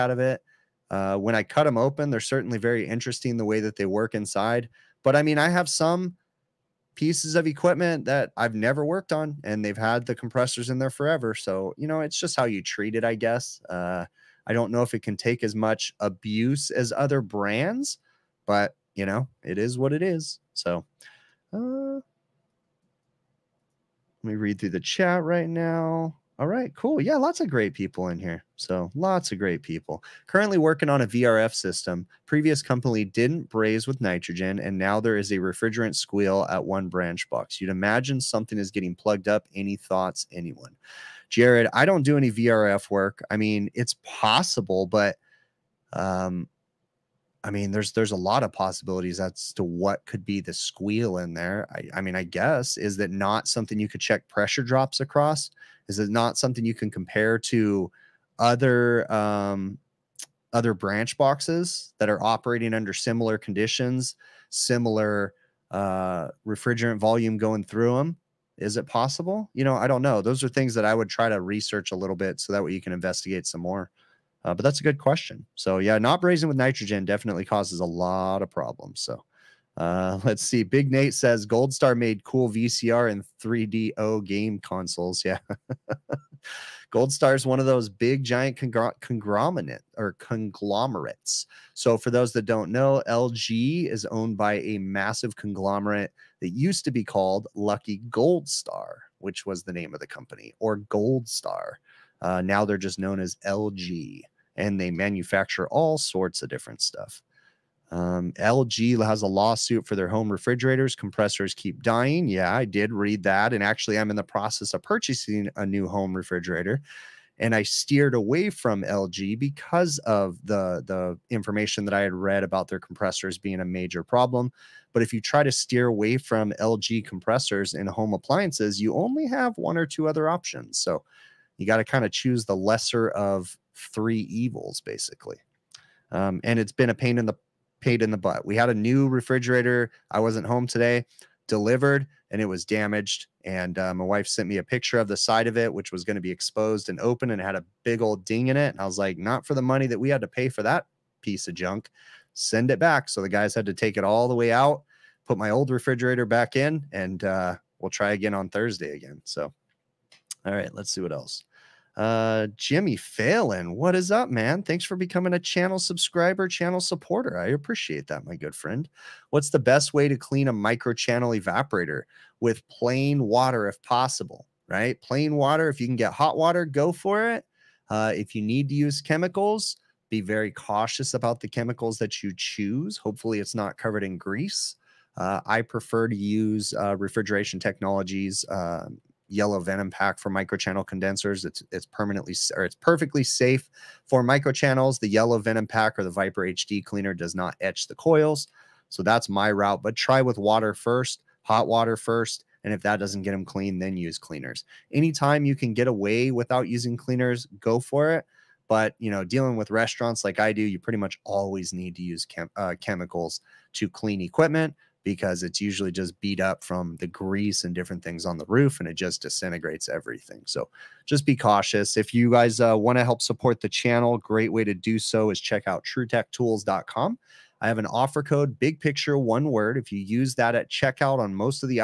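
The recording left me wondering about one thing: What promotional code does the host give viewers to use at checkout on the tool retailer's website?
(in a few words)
big picture.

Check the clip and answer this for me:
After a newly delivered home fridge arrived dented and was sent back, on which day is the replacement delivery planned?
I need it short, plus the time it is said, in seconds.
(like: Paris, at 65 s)
Thursday, at 158 s.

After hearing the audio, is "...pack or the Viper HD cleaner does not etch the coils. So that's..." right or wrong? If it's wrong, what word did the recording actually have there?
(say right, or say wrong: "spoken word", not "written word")
right.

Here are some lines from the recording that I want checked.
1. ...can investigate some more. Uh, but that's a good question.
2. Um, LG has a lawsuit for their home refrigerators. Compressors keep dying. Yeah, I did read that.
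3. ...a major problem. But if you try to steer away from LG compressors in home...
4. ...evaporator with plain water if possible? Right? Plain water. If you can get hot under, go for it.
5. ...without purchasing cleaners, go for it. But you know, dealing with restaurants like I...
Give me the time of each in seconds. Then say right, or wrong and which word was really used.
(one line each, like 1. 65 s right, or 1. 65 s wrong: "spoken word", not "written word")
1. 72 s right
2. 107 s right
3. 123 s right
4. 171 s wrong: "water", not "under"
5. 206 s wrong: "using", not "purchasing".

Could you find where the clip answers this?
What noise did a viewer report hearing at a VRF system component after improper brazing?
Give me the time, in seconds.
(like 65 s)
35 s.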